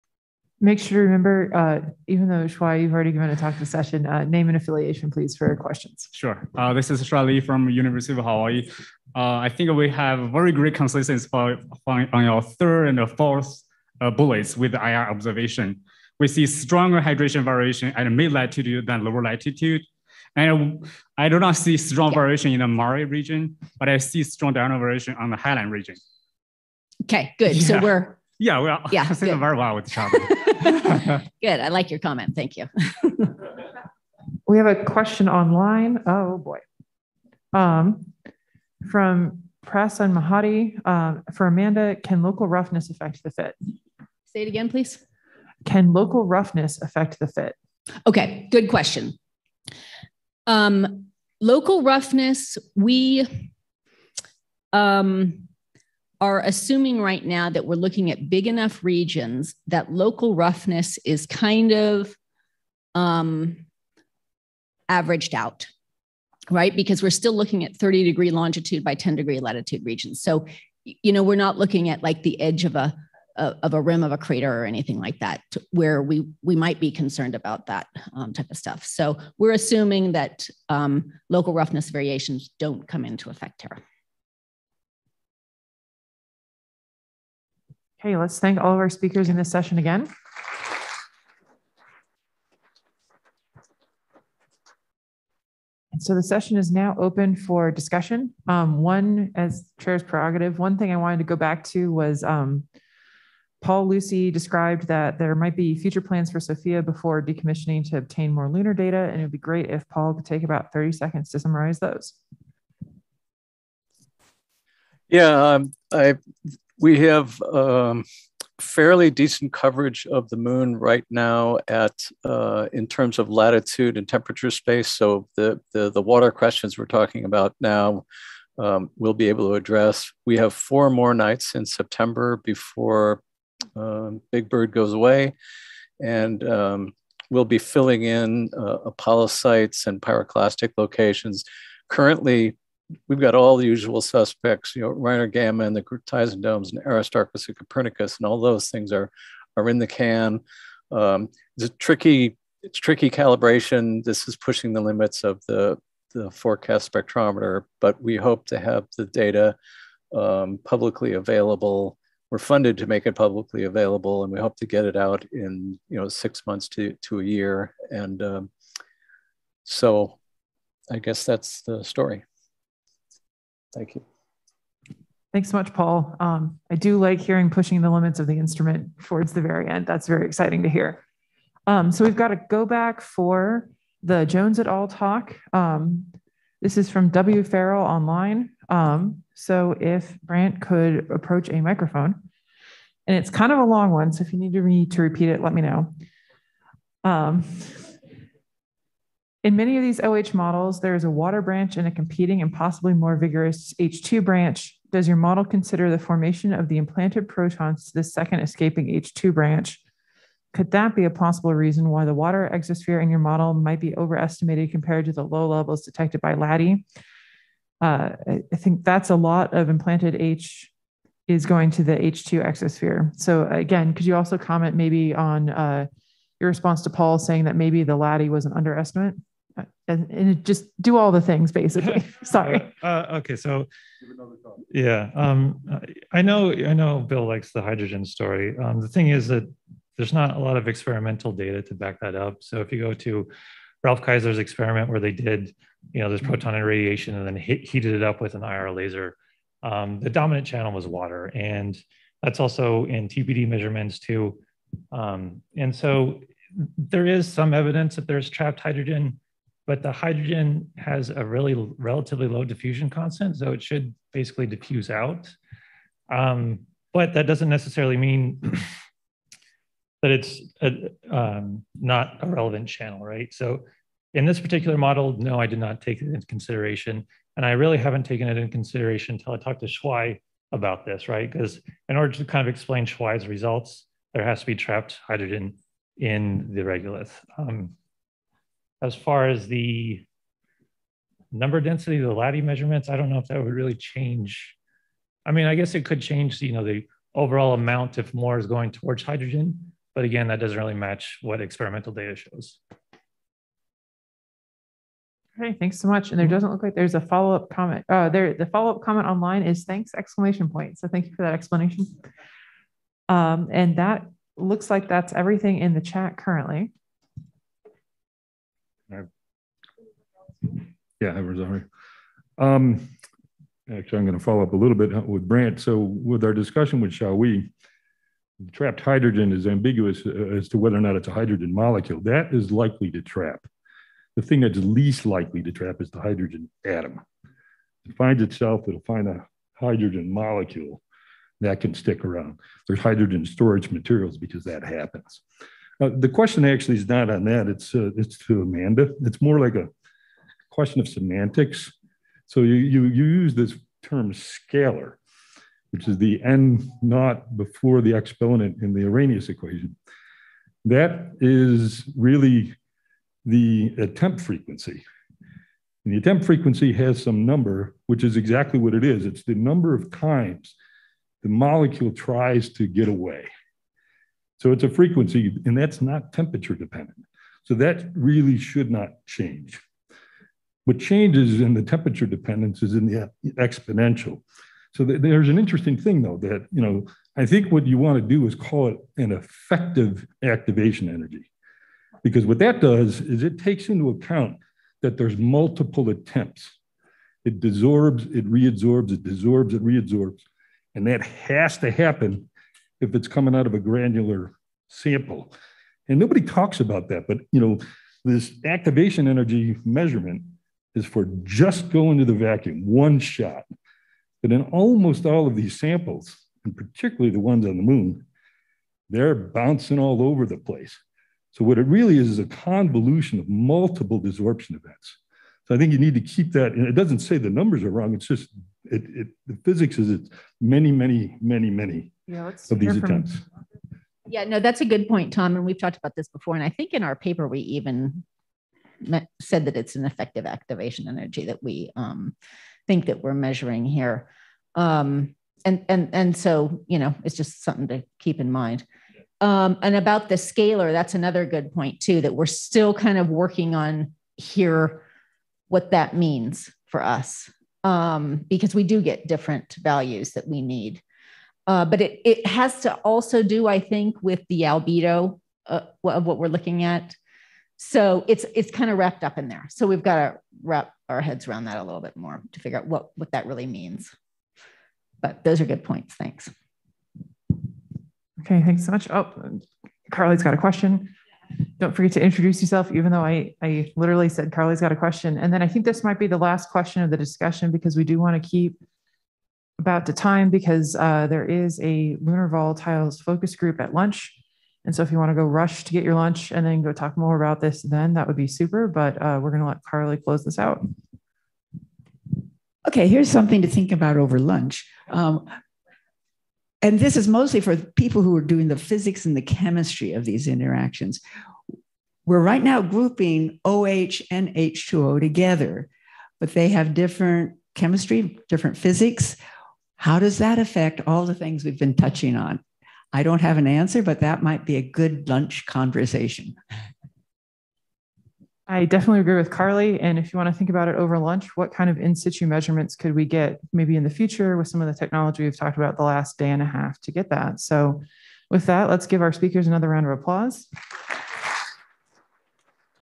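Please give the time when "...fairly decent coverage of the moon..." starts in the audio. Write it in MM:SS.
01:58.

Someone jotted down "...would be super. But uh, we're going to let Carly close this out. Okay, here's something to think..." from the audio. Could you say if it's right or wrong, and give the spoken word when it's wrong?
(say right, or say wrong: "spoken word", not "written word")
right.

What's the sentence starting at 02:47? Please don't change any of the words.
And um, so, I guess that's the story.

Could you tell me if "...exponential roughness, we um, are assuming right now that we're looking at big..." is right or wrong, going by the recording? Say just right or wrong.
wrong.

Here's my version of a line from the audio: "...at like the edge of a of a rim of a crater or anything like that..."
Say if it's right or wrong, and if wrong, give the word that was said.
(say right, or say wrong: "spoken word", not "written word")
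right.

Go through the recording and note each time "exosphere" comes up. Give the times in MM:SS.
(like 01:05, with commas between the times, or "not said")
03:32, 03:42.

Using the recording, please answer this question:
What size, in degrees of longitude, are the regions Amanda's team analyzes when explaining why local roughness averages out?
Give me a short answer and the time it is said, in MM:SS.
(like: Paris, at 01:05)
30, at 01:07.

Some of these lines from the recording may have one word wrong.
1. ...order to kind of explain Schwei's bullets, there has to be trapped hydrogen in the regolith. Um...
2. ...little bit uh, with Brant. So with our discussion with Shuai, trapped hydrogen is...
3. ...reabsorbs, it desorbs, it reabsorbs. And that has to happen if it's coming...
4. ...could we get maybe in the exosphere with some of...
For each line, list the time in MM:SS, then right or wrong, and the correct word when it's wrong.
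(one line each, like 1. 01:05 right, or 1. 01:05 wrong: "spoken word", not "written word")
1. 04:41 wrong: "results", not "bullets"
2. 05:24 right
3. 06:38 right
4. 08:52 wrong: "future", not "exosphere".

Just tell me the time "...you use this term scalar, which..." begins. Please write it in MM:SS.
05:52.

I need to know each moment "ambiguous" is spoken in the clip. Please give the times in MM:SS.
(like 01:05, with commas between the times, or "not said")
05:29.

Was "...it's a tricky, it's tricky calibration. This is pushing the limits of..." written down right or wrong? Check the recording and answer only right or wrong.
right.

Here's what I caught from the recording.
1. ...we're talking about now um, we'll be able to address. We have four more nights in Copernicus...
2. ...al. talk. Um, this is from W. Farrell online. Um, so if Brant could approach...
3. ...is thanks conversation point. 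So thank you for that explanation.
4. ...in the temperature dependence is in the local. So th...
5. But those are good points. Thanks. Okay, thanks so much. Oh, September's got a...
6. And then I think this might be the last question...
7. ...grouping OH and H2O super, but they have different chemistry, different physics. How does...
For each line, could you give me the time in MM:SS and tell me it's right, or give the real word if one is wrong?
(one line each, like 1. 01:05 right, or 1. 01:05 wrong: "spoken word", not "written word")
1. 02:06 wrong: "September", not "Copernicus"
2. 03:04 right
3. 05:09 wrong: "exclamation", not "conversation"
4. 06:21 wrong: "exponential", not "local"
5. 07:54 wrong: "Carly", not "September"
6. 08:05 right
7. 08:32 wrong: "together", not "super".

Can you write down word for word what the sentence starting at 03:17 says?
Um, in many of these OH models, there is a water branch and a competing and possibly more vigorous H2 branch.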